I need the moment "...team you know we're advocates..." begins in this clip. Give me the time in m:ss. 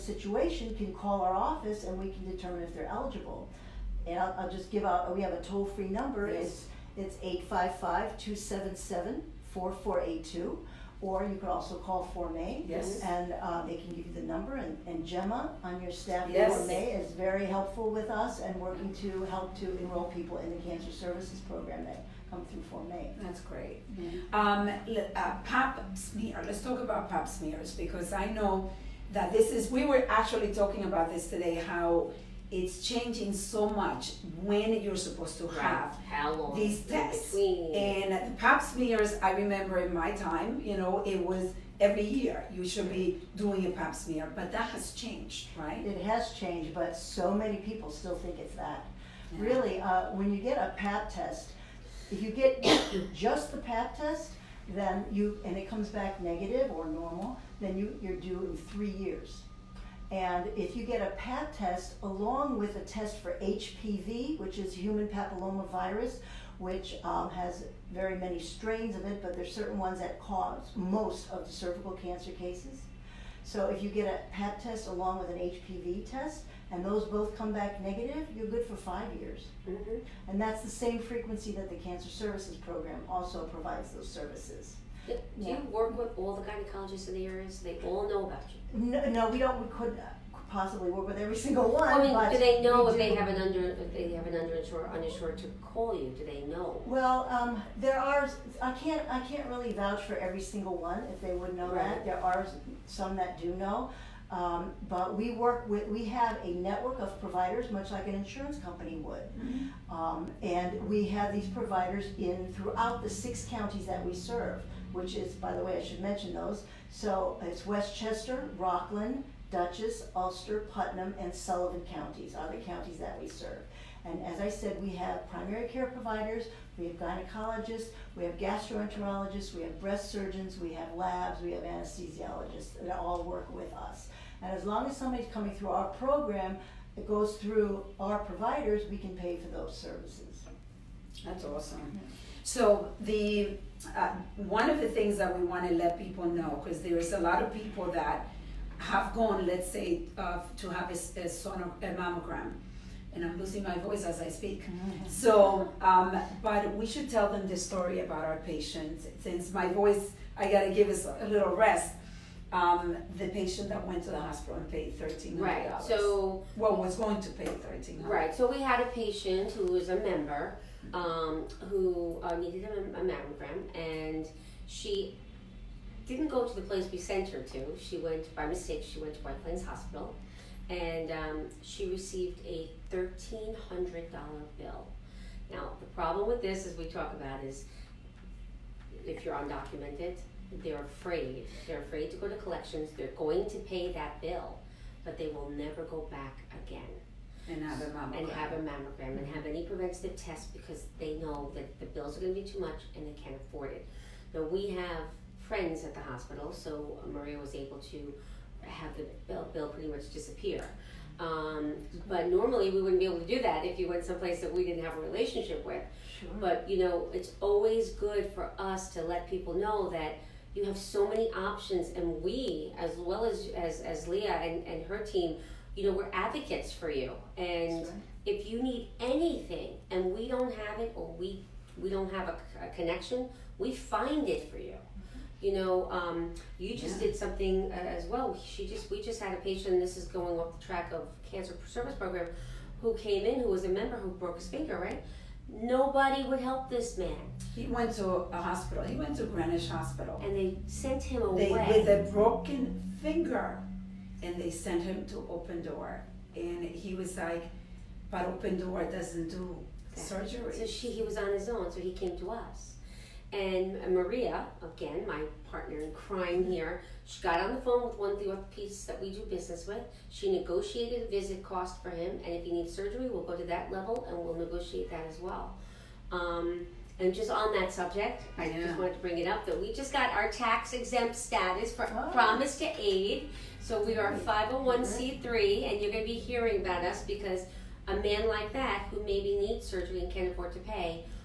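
3:44.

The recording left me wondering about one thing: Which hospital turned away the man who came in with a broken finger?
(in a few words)
Greenwich Hospital.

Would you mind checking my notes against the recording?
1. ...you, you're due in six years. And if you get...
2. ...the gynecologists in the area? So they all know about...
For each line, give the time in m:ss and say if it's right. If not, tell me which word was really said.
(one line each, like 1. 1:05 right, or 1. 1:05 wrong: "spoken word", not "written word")
1. 0:57 wrong: "three", not "six"
2. 1:26 right.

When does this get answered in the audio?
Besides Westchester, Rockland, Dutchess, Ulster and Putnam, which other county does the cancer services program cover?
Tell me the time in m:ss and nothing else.
2:01.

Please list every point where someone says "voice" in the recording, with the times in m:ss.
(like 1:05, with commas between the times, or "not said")
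2:33, 2:39.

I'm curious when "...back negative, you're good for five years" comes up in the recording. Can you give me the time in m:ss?
1:17.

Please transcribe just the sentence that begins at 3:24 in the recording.
Now, we have friends at the hospital, so Maria was able to have the bill, bill pretty much disappear.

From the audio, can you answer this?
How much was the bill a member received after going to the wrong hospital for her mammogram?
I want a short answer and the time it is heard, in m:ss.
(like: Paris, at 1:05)
$1,300, at 3:02.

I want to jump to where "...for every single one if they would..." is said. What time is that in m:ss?
1:40.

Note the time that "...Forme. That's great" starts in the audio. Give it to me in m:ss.
0:22.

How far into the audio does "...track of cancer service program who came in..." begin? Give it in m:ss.
4:00.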